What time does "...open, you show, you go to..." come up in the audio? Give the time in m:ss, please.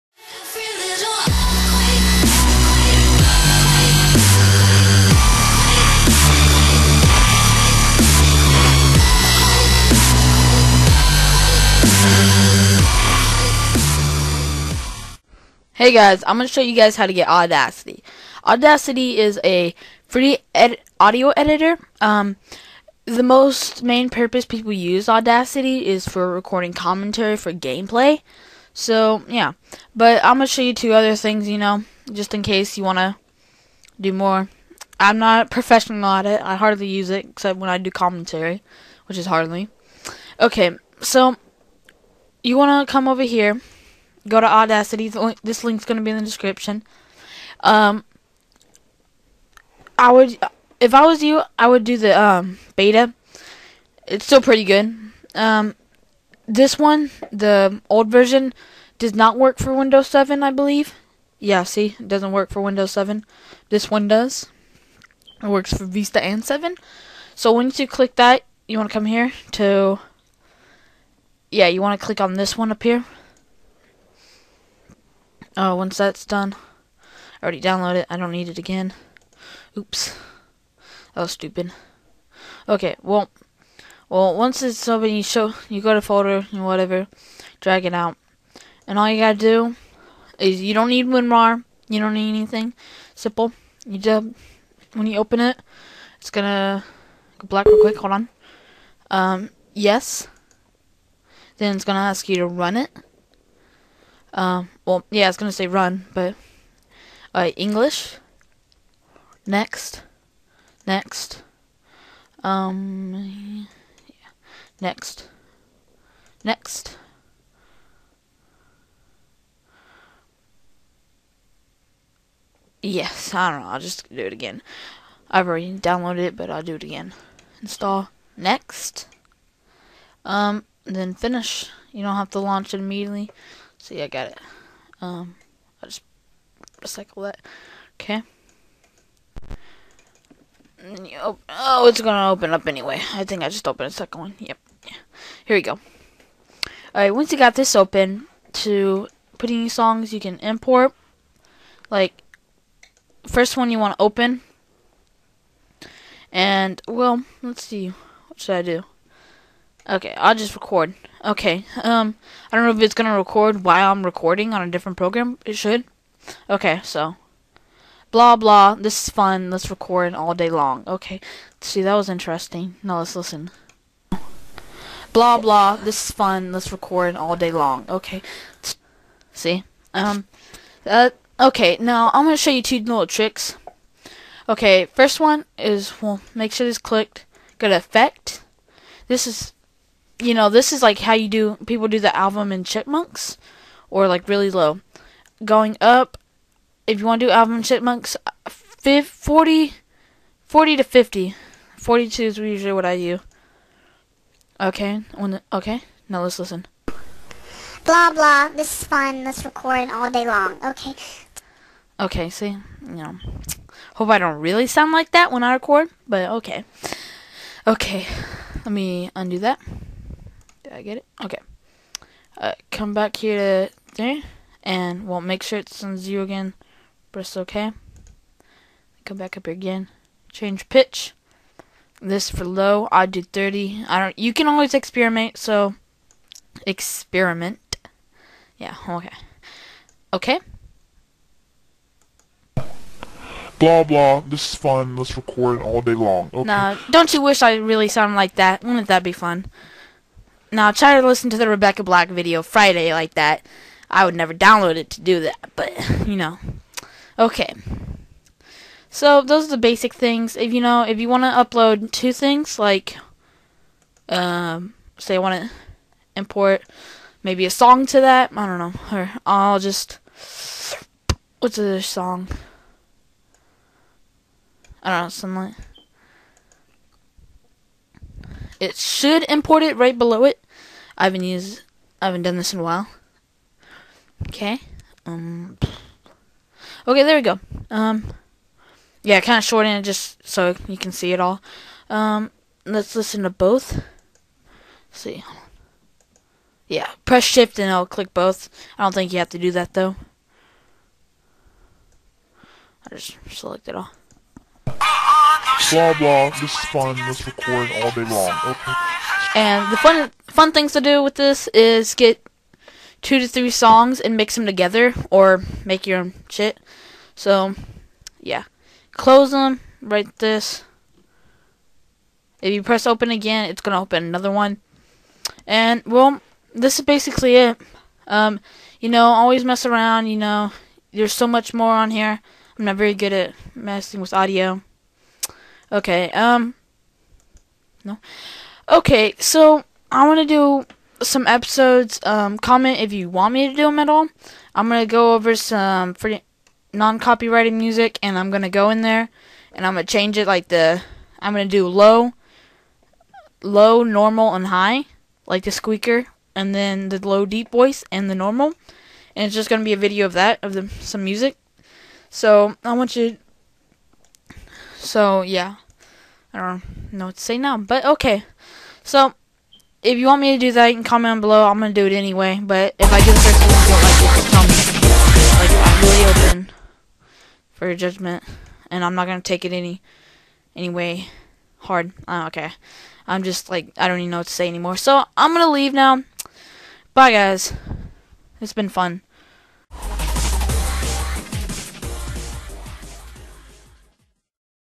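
1:24.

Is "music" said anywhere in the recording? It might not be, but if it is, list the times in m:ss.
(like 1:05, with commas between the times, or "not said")
5:47, 6:01.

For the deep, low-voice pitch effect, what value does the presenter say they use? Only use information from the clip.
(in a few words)
30.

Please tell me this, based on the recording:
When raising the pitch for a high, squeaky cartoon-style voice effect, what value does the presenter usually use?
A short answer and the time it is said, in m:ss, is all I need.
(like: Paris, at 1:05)
42, at 3:21.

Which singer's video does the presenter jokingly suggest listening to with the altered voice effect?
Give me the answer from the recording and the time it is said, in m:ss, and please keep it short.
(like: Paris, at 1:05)
Rebecca Black, at 4:11.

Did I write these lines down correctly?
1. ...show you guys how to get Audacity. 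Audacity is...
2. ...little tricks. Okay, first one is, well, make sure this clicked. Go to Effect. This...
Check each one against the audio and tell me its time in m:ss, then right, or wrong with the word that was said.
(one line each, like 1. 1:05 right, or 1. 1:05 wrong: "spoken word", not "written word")
1. 0:16 right
2. 3:02 right.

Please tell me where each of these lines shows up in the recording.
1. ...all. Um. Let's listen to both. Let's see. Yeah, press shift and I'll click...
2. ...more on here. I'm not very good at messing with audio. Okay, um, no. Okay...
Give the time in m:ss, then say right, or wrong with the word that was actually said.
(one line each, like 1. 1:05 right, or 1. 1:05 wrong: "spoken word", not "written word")
1. 4:51 right
2. 5:31 right.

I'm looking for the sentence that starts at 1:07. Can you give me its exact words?
So once you click that, you want to come here to yeah, you want to click on this one up here.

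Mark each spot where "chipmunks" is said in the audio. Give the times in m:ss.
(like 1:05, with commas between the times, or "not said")
3:12, 3:17.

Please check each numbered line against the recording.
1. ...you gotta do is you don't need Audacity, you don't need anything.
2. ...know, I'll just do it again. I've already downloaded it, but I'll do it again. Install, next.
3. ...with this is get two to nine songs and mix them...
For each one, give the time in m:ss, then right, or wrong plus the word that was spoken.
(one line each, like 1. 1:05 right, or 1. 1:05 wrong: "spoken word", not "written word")
1. 1:29 wrong: "WinRAR", not "Audacity"
2. 2:03 right
3. 5:11 wrong: "three", not "nine".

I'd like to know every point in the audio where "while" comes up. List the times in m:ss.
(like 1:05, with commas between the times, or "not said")
2:43, 4:42.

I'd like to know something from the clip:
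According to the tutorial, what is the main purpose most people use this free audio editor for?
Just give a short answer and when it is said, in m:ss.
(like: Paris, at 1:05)
Recording commentary for gameplay, at 0:26.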